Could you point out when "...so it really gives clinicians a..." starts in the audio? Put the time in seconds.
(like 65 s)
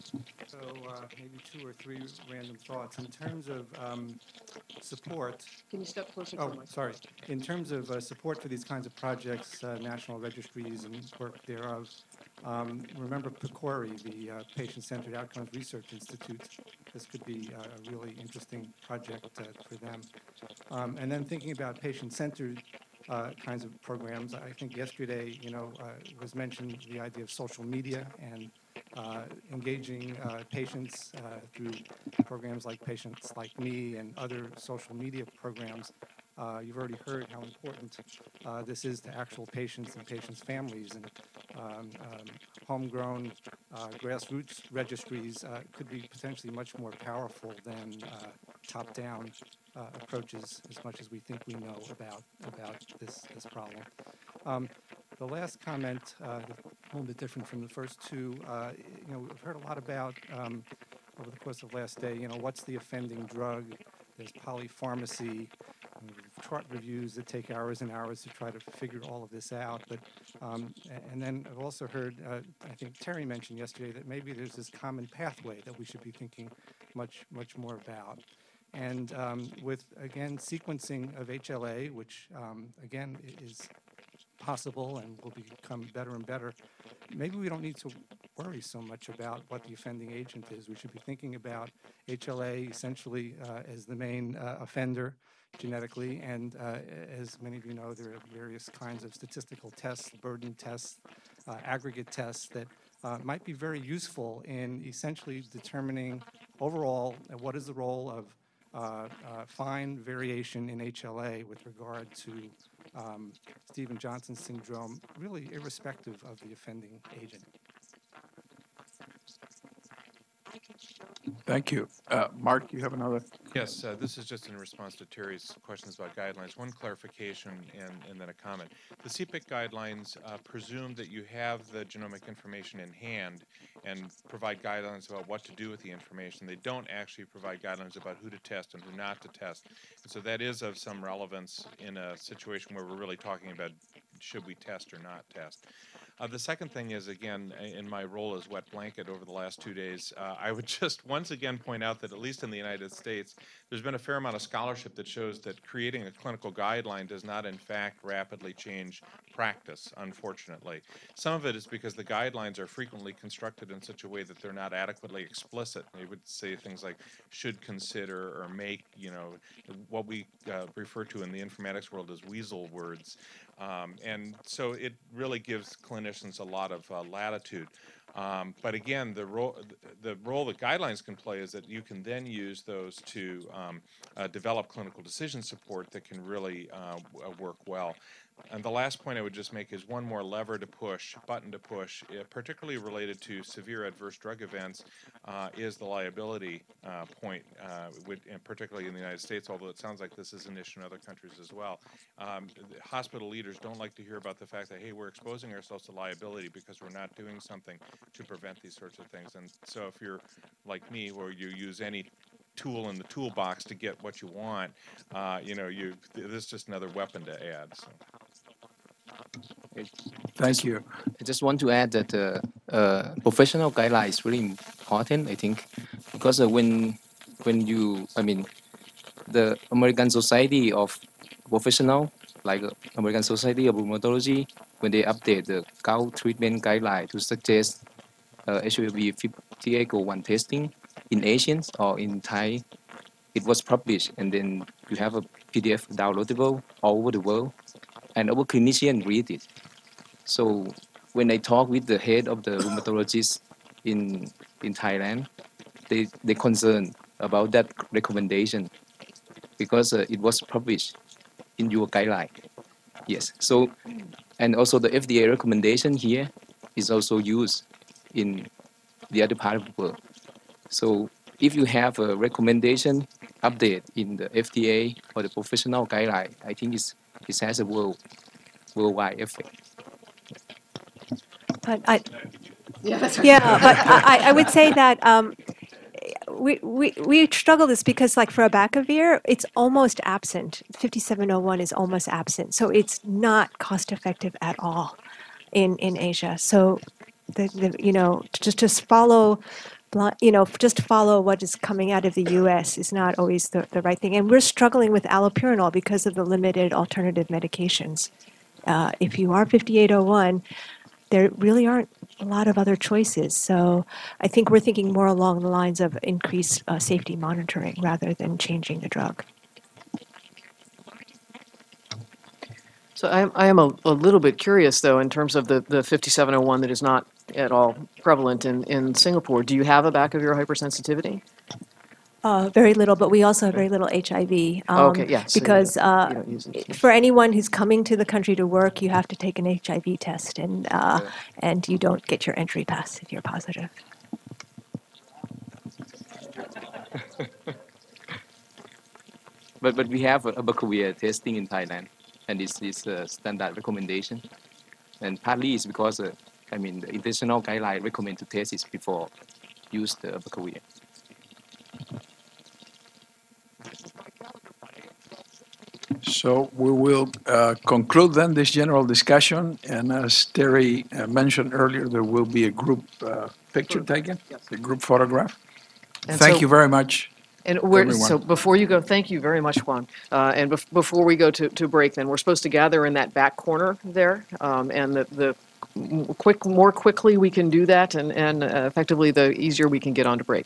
174 s.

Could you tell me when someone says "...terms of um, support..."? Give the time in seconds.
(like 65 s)
3 s.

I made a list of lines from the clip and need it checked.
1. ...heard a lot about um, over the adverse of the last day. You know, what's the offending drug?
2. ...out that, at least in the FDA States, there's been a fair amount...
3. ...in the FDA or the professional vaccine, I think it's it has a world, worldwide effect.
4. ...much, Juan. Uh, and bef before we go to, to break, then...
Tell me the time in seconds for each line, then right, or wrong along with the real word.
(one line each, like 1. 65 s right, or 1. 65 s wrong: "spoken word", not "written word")
1. 59 s wrong: "course", not "adverse"
2. 151 s wrong: "United", not "FDA"
3. 273 s wrong: "guideline", not "vaccine"
4. 379 s right.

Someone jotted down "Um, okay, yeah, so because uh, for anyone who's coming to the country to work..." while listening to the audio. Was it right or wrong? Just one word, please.
right.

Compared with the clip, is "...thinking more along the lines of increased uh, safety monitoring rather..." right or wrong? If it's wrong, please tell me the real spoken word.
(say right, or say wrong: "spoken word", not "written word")
right.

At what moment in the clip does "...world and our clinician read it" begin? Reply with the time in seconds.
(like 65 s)
247 s.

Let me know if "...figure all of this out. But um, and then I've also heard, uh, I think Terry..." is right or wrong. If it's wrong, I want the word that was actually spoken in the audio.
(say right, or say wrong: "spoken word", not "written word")
right.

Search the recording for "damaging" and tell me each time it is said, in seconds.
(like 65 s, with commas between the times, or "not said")
not said.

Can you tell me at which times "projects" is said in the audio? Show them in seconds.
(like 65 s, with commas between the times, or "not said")
8 s, 18 s.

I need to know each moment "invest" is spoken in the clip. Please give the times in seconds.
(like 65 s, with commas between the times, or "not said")
not said.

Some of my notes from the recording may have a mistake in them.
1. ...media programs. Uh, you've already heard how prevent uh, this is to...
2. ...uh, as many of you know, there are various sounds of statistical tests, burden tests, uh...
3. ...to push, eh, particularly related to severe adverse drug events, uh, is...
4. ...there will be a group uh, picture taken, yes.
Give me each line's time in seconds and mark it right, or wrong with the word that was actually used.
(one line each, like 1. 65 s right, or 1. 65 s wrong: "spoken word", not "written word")
1. 34 s wrong: "important", not "prevent"
2. 96 s wrong: "kinds", not "sounds"
3. 191 s right
4. 371 s right.